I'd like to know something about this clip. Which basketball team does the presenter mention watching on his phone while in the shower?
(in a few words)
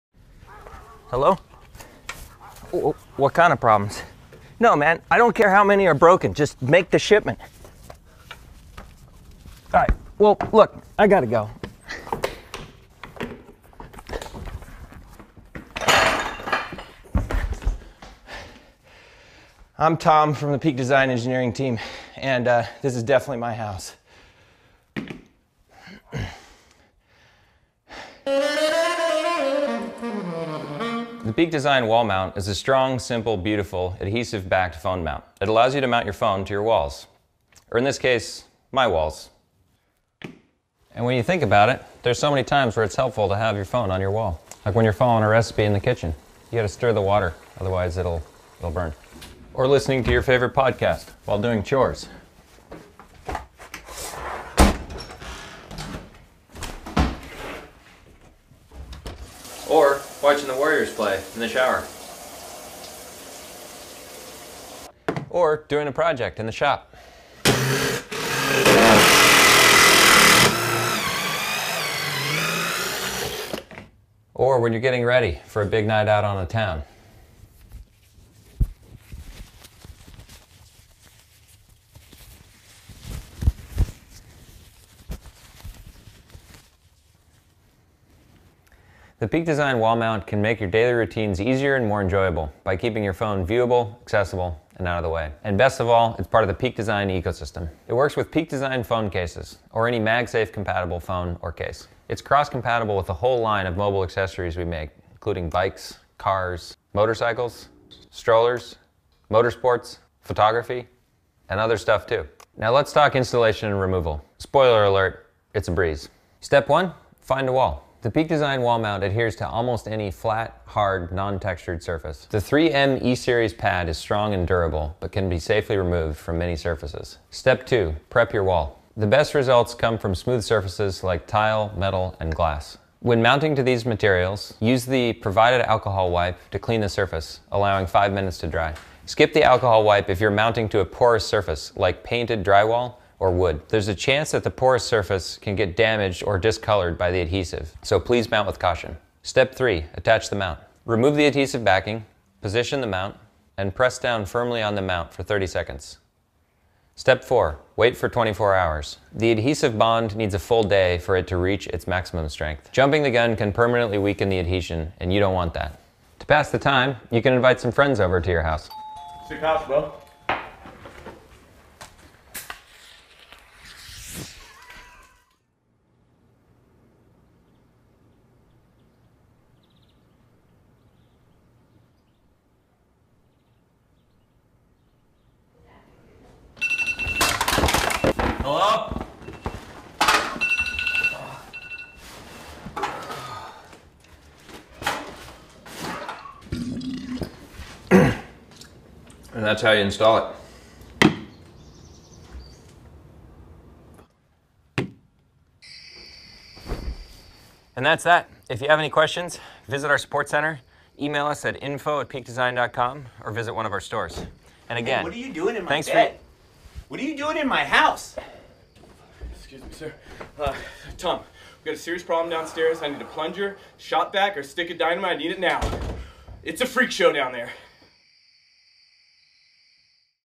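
Warriors.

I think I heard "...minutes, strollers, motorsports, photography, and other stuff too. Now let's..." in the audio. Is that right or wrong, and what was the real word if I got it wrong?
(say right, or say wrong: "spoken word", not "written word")
wrong: "motorcycles", not "minutes".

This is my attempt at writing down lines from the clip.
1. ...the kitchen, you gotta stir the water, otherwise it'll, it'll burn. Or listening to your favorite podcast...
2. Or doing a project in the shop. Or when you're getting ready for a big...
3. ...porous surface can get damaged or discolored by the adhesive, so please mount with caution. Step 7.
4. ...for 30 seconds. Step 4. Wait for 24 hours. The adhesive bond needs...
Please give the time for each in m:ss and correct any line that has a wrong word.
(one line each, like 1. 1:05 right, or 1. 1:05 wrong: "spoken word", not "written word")
1. 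0:45 right
2. 1:05 right
3. 2:24 wrong: "3", not "7"
4. 2:35 right.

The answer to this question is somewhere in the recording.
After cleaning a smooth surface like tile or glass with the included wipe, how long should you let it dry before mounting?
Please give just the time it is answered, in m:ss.
2:17.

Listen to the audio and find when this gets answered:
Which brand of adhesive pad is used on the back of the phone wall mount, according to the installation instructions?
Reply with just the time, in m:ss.
2:02.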